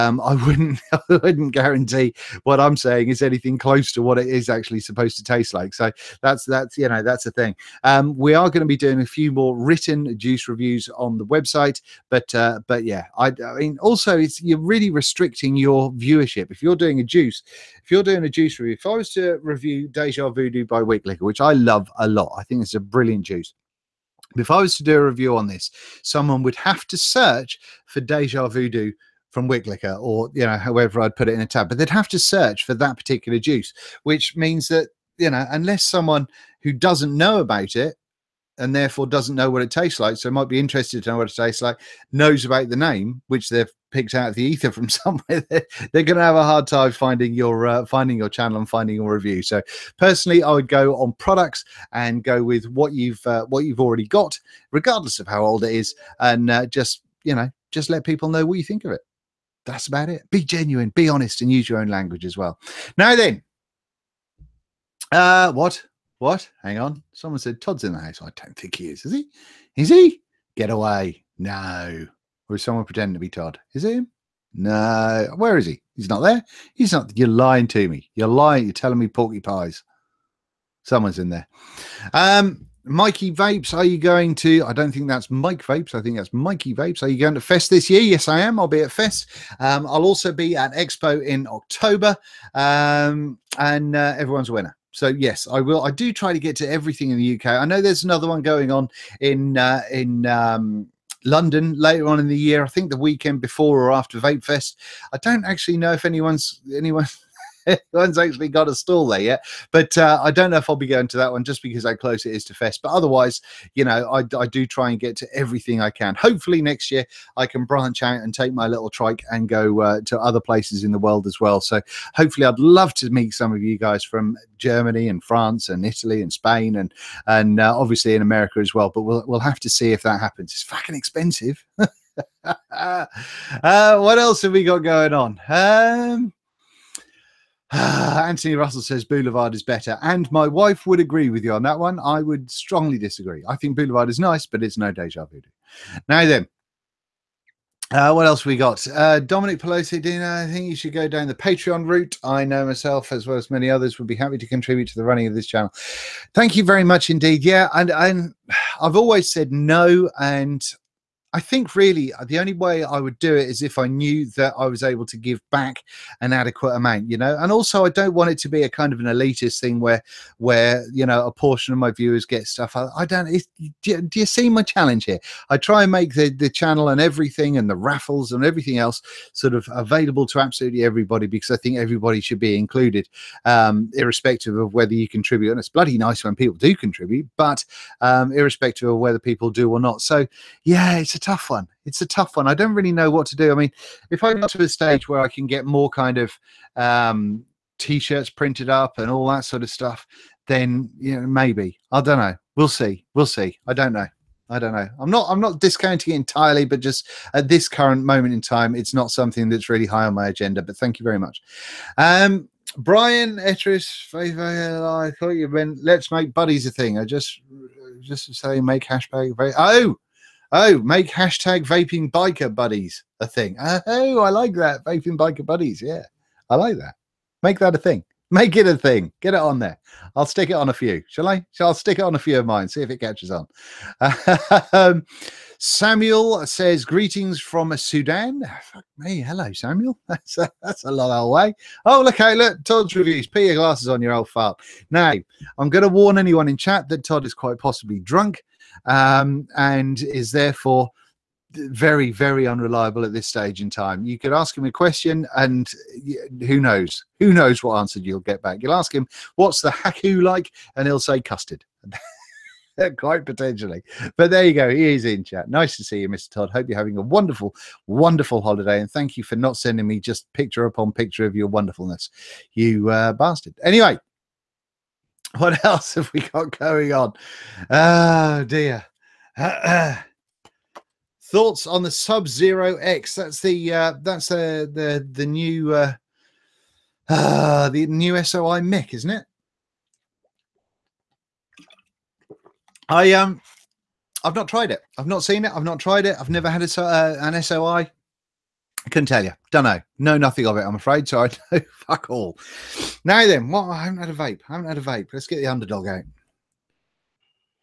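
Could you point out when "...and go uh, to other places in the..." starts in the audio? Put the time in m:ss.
1:59.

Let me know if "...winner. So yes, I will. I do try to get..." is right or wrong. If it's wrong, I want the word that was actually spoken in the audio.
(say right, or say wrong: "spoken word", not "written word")
right.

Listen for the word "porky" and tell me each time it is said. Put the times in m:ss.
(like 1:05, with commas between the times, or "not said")
1:19.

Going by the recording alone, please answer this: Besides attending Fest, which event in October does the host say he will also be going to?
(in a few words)
Expo.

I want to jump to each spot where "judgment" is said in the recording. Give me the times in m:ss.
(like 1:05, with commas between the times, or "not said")
not said.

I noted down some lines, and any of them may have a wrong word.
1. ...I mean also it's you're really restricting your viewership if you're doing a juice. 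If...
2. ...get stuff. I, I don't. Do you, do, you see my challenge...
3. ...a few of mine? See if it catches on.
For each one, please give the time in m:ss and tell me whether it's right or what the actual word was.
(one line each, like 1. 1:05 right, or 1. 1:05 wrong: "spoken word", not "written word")
1. 0:13 right
2. 2:52 right
3. 3:52 right.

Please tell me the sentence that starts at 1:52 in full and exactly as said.
But otherwise, you know, I, I do try and get to everything I can.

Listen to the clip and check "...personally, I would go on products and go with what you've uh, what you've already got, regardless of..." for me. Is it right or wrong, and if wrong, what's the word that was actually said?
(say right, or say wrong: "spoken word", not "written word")
right.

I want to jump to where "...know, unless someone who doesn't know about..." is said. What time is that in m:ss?
0:35.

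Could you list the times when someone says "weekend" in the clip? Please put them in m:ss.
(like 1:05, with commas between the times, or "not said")
1:42.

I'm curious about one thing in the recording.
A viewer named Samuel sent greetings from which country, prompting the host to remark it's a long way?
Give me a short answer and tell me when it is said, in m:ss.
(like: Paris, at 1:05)
Sudan, at 3:57.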